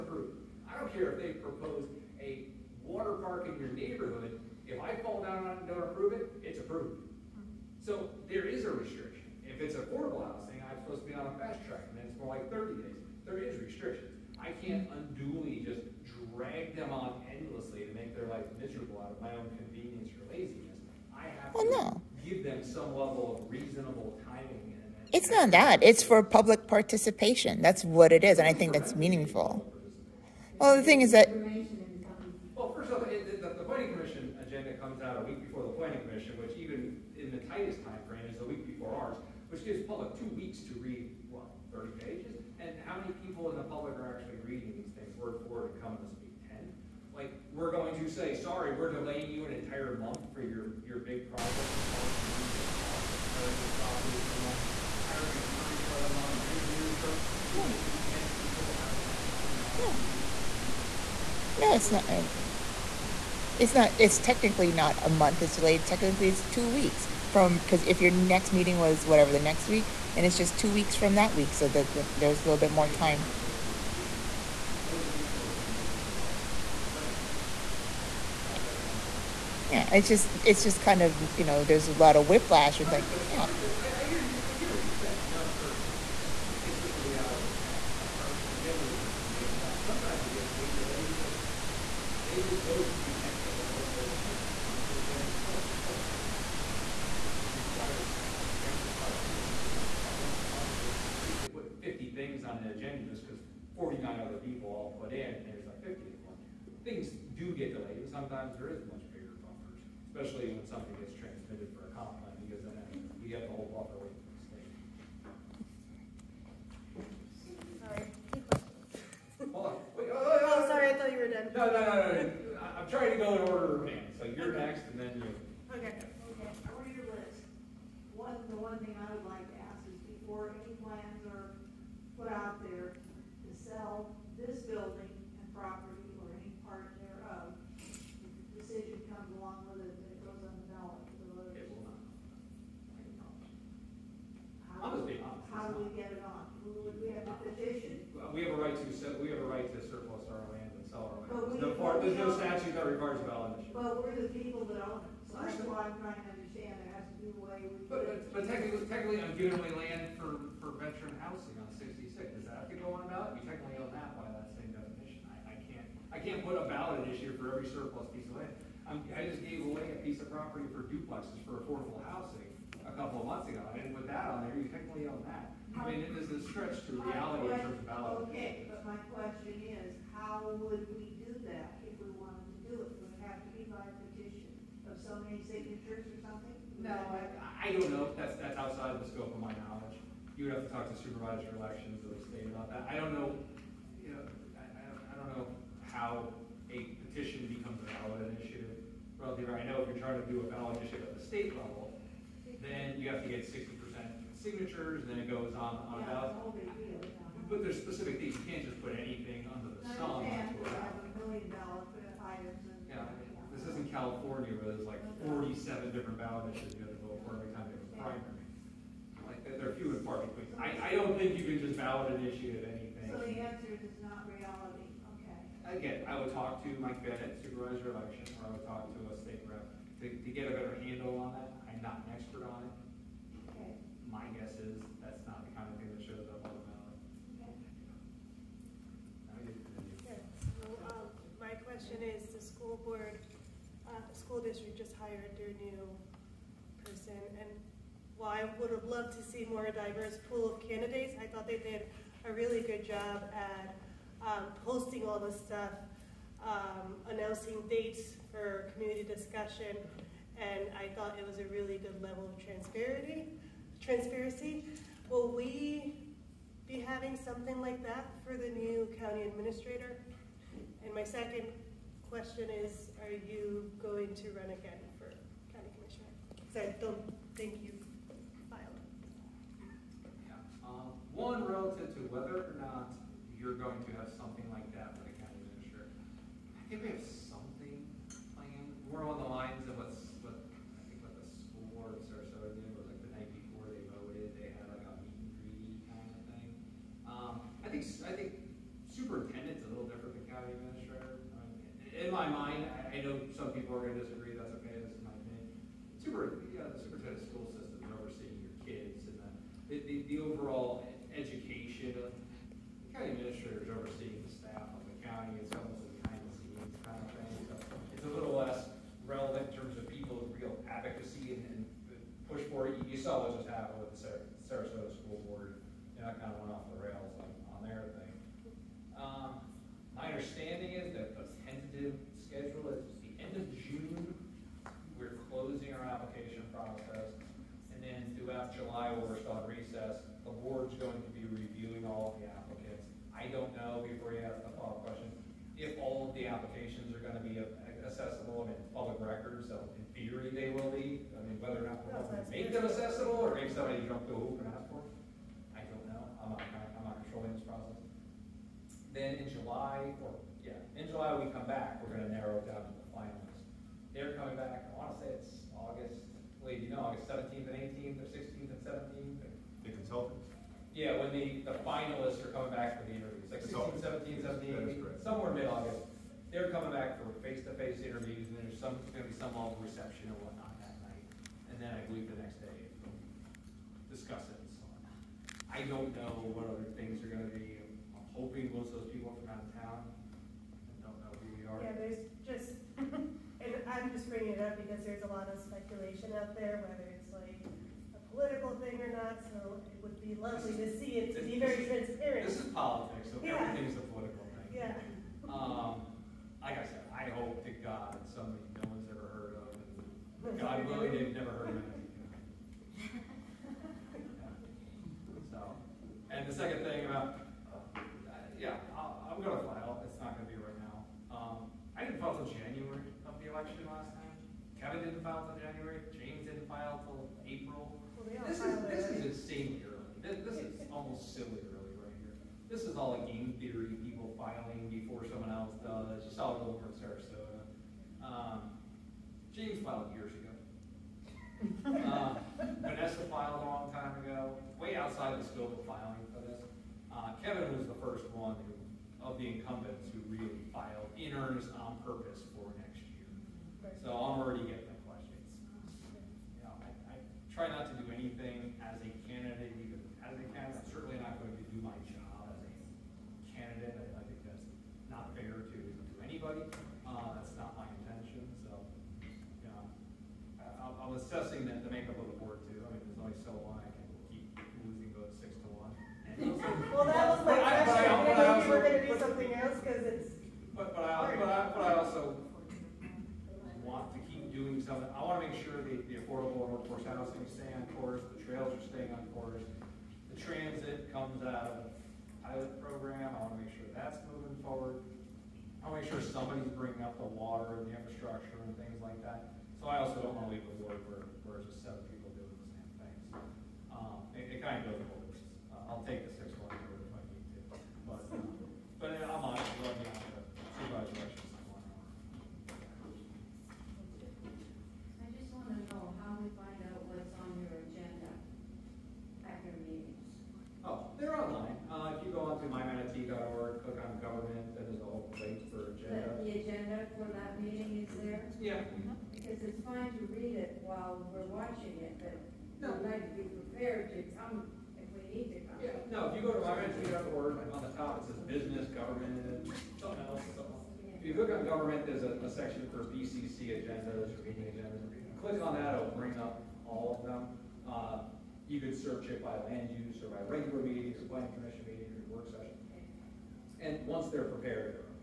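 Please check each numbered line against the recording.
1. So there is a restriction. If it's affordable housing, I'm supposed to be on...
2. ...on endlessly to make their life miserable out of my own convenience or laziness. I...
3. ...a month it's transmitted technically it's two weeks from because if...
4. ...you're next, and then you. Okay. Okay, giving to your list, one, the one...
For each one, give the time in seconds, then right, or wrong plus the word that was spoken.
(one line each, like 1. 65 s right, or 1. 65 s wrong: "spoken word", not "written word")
1. 7 s right
2. 16 s right
3. 65 s wrong: "delayed", not "transmitted"
4. 124 s wrong: "according", not "giving".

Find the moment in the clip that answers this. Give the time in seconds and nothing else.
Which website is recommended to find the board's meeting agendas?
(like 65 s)
522 s.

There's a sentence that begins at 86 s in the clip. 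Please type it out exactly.
it's just the reality of our, agendas are jammed up sometimes you they just go to the next available agenda.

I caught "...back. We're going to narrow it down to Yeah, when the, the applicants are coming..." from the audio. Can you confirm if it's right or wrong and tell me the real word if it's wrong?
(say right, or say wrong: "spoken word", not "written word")
wrong: "finalists", not "applicants".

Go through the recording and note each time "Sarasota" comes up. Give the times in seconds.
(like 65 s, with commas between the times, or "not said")
292 s, 324 s, 436 s.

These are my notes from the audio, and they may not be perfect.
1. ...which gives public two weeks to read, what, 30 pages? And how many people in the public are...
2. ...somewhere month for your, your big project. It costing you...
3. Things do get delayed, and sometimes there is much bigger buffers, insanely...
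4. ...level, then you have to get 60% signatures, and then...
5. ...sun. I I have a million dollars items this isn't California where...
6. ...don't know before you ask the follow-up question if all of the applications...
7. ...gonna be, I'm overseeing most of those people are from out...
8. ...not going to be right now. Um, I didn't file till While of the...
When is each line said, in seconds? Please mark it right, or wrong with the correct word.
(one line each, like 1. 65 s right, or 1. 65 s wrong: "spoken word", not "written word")
1. 39 s right
2. 49 s wrong: "entire", not "somewhere"
3. 106 s wrong: "especially", not "insanely"
4. 201 s right
5. 209 s right
6. 343 s right
7. 387 s wrong: "hoping", not "overseeing"
8. 419 s wrong: "January", not "While".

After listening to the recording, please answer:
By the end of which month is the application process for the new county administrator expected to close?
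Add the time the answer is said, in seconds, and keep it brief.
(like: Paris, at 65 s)
June, at 333 s.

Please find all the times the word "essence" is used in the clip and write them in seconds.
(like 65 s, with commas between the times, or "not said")
not said.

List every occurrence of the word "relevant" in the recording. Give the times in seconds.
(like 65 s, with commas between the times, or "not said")
319 s.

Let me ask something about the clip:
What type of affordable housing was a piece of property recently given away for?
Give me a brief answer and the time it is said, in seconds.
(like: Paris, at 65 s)
Duplexes, at 170 s.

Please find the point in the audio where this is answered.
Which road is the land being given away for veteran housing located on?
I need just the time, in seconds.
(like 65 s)
161 s.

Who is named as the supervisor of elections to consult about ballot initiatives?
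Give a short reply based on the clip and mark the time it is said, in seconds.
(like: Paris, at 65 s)
Mike Bennett, at 226 s.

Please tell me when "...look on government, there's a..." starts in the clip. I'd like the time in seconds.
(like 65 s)
541 s.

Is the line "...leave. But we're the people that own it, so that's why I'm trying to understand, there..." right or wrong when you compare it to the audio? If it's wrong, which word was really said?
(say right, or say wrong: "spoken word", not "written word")
wrong: "initiative", not "leave".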